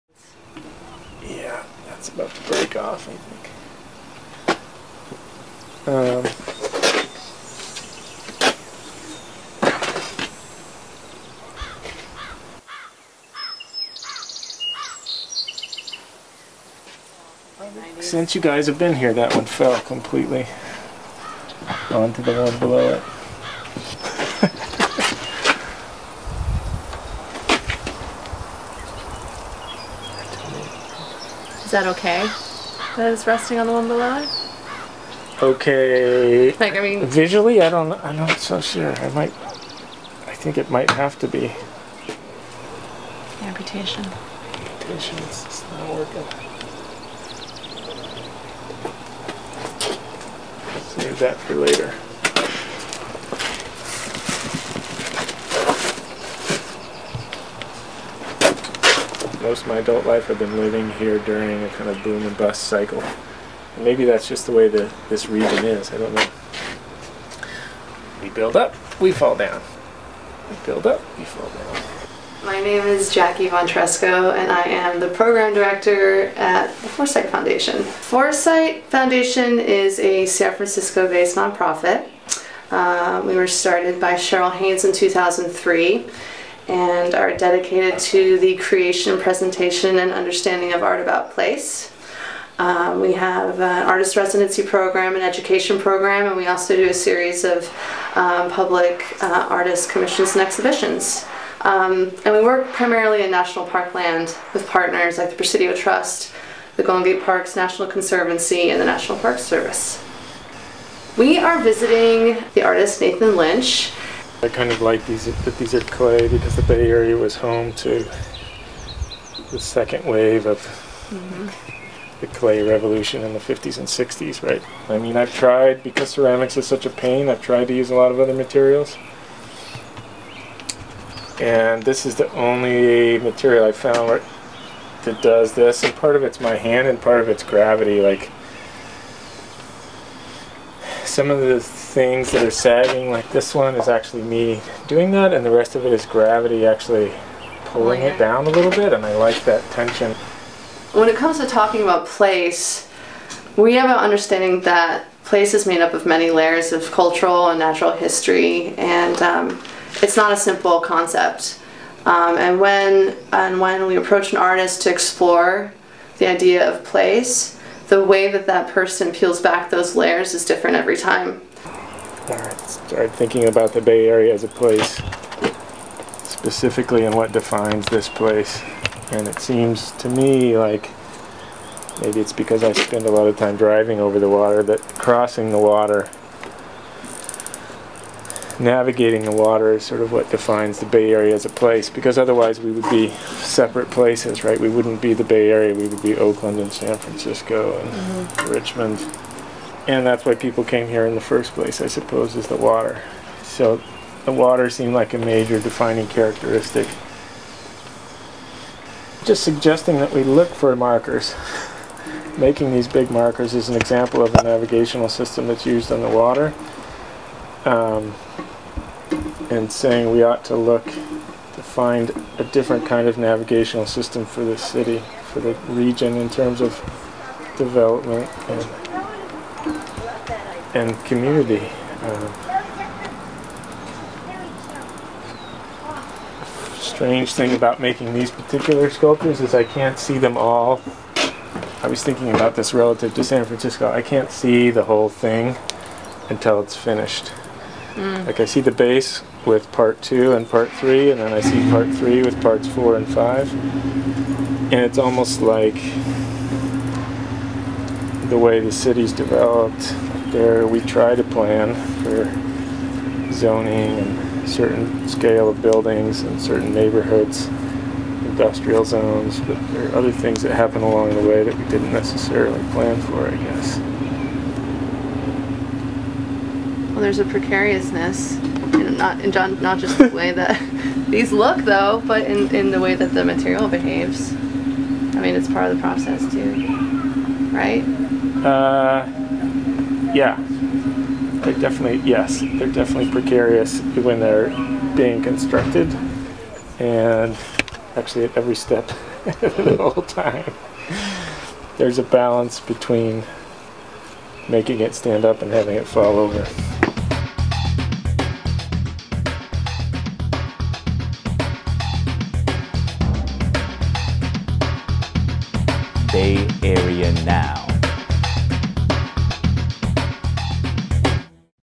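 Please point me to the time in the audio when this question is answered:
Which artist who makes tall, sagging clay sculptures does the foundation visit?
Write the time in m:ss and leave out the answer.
1:53.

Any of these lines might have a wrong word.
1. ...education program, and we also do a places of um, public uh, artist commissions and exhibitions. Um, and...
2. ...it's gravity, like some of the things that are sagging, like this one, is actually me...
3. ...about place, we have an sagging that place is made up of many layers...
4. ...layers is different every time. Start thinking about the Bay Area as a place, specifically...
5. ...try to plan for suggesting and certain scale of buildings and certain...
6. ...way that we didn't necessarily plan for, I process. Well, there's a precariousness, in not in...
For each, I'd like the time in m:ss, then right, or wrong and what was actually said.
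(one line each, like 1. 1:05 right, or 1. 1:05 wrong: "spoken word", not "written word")
1. 1:35 wrong: "series", not "places"
2. 2:17 right
3. 2:31 wrong: "understanding", not "sagging"
4. 2:49 right
5. 4:20 wrong: "zoning", not "suggesting"
6. 4:31 wrong: "guess", not "process".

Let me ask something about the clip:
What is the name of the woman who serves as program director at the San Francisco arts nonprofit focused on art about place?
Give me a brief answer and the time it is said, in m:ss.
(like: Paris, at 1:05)
Jackie Montresco, at 1:13.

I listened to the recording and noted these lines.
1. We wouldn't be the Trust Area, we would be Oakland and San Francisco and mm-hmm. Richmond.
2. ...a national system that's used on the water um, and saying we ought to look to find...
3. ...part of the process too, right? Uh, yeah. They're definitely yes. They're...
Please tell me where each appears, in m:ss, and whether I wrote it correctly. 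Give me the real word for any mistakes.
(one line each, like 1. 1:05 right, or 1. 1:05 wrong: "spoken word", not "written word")
1. 3:14 wrong: "Bay", not "Trust"
2. 3:34 wrong: "navigational", not "national"
3. 4:45 right.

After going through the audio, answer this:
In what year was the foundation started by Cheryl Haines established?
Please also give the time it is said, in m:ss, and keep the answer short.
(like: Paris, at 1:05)
2003, at 1:24.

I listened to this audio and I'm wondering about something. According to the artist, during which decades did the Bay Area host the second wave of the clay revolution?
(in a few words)
the 50s and 60s.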